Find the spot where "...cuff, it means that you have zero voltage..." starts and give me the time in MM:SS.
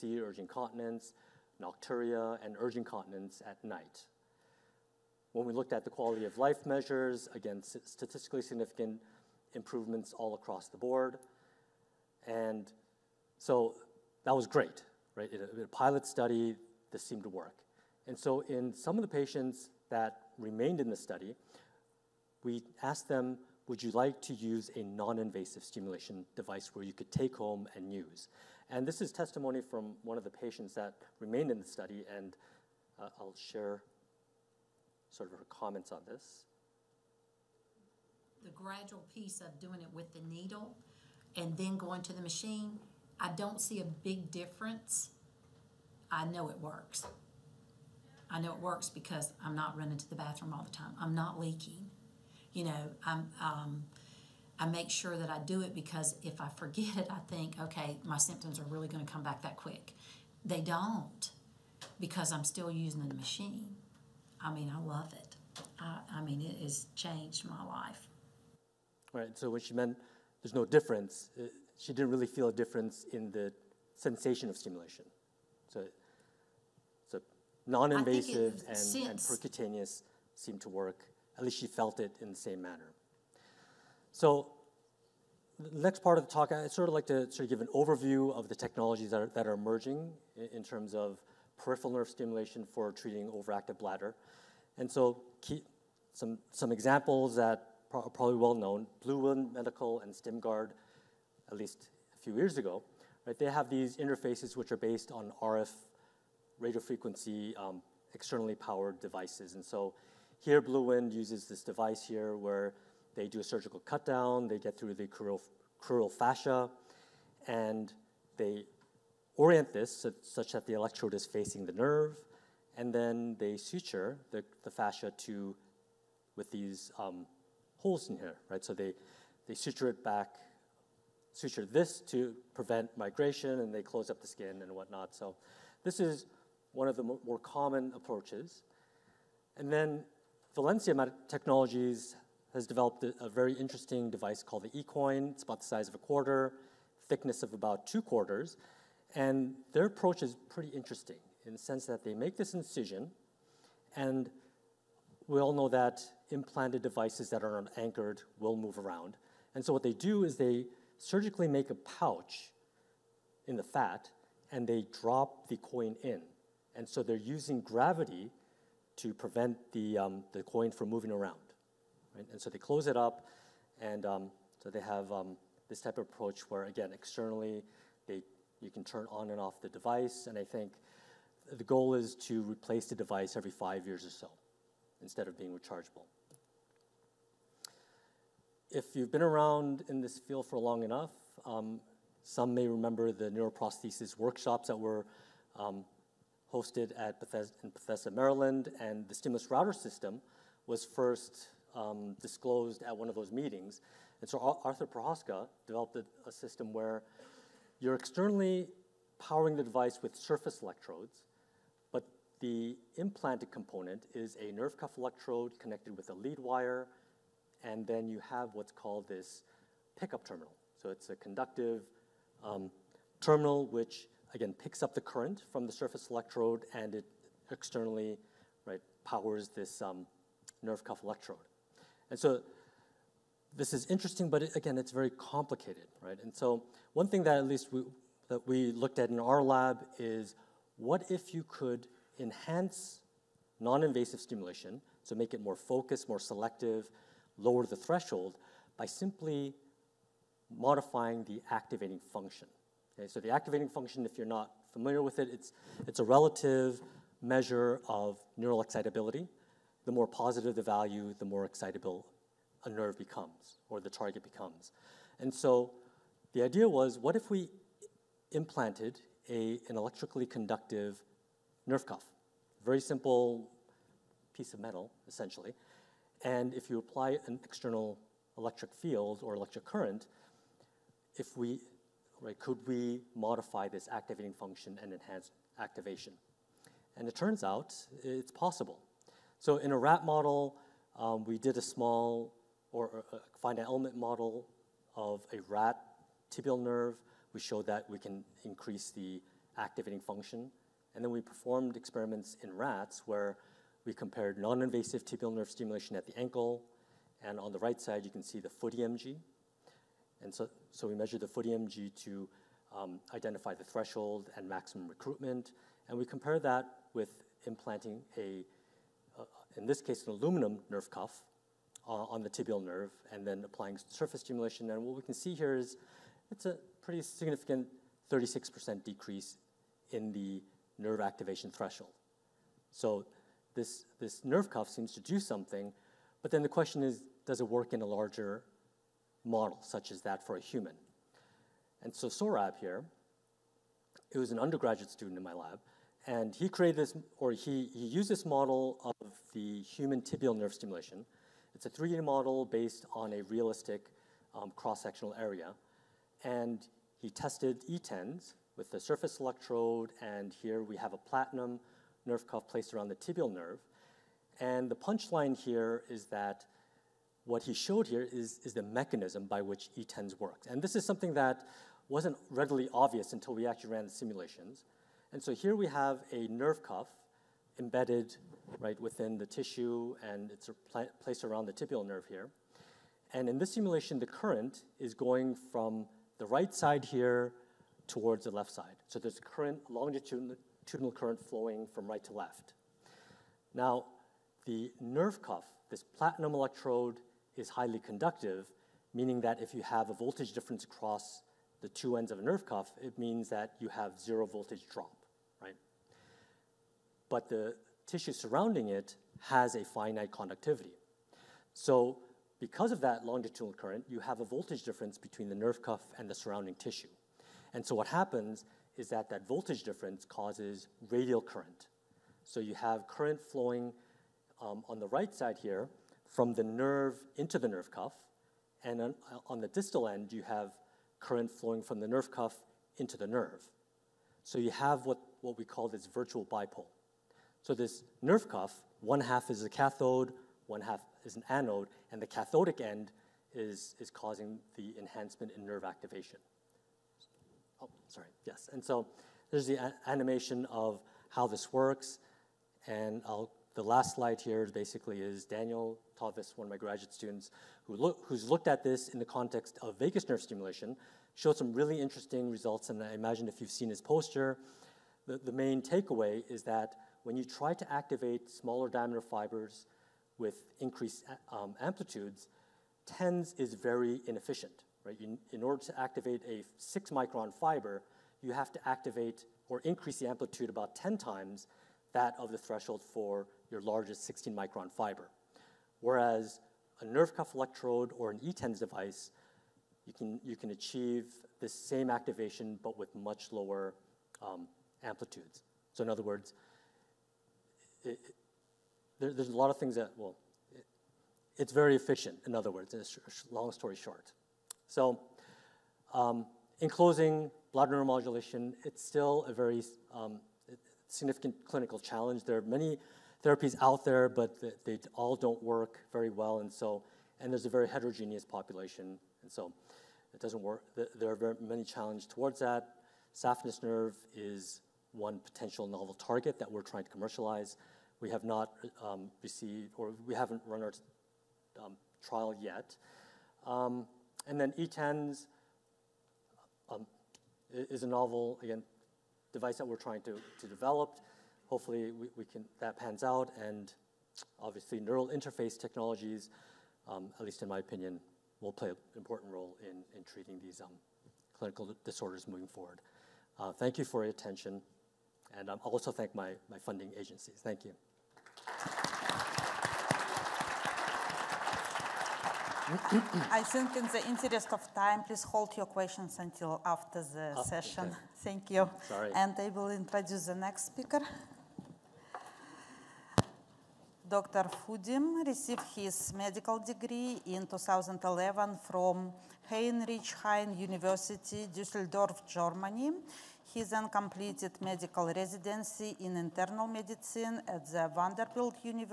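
06:42.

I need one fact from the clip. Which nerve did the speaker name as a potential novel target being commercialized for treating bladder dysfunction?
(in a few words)
saphenous nerve.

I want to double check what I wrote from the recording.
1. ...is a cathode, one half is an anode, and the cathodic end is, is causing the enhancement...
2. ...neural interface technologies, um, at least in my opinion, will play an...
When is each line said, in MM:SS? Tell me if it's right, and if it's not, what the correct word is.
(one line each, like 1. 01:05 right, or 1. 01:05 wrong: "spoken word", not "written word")
1. 07:19 right
2. 09:04 right.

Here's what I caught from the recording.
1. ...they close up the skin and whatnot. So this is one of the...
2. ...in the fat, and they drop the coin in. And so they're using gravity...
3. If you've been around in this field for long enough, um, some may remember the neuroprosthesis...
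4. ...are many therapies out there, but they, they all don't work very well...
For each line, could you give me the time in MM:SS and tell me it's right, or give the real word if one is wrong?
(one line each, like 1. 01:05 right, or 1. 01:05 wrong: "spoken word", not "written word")
1. 02:13 right
2. 02:43 right
3. 03:08 right
4. 08:32 right.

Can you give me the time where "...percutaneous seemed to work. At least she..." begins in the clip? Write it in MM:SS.
01:19.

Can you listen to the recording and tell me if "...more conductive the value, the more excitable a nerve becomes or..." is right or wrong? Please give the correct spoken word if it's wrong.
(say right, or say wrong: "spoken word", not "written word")
wrong: "positive", not "conductive".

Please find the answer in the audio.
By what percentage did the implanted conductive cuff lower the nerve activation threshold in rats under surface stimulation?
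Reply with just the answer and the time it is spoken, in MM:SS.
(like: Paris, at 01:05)
36%, at 05:28.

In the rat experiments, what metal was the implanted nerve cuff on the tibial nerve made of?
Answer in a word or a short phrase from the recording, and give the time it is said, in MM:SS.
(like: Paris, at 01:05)
aluminum, at 05:20.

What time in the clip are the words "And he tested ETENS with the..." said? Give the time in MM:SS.
05:56.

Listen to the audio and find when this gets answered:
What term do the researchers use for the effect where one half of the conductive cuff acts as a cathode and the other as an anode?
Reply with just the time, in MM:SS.
07:15.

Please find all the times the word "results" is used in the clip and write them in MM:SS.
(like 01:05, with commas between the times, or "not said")
07:42.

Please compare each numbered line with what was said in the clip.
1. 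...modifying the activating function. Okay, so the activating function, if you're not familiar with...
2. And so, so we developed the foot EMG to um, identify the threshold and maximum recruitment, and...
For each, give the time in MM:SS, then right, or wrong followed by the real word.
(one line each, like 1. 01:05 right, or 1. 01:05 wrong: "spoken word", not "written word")
1. 04:10 right
2. 05:10 wrong: "measured", not "developed".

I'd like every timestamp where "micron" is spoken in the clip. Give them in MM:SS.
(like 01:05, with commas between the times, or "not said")
07:56, 08:04.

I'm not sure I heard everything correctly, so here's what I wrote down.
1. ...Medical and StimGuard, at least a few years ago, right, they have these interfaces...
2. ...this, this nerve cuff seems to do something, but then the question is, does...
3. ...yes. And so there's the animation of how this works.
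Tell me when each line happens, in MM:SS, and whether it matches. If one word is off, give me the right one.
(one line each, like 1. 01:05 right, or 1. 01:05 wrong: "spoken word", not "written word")
1. 01:39 right
2. 05:33 right
3. 07:28 right.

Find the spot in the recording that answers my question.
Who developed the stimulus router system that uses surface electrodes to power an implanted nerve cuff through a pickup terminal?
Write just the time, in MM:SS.
03:24.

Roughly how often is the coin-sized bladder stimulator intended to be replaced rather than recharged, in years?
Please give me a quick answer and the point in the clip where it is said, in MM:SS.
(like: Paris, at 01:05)
5, at 03:03.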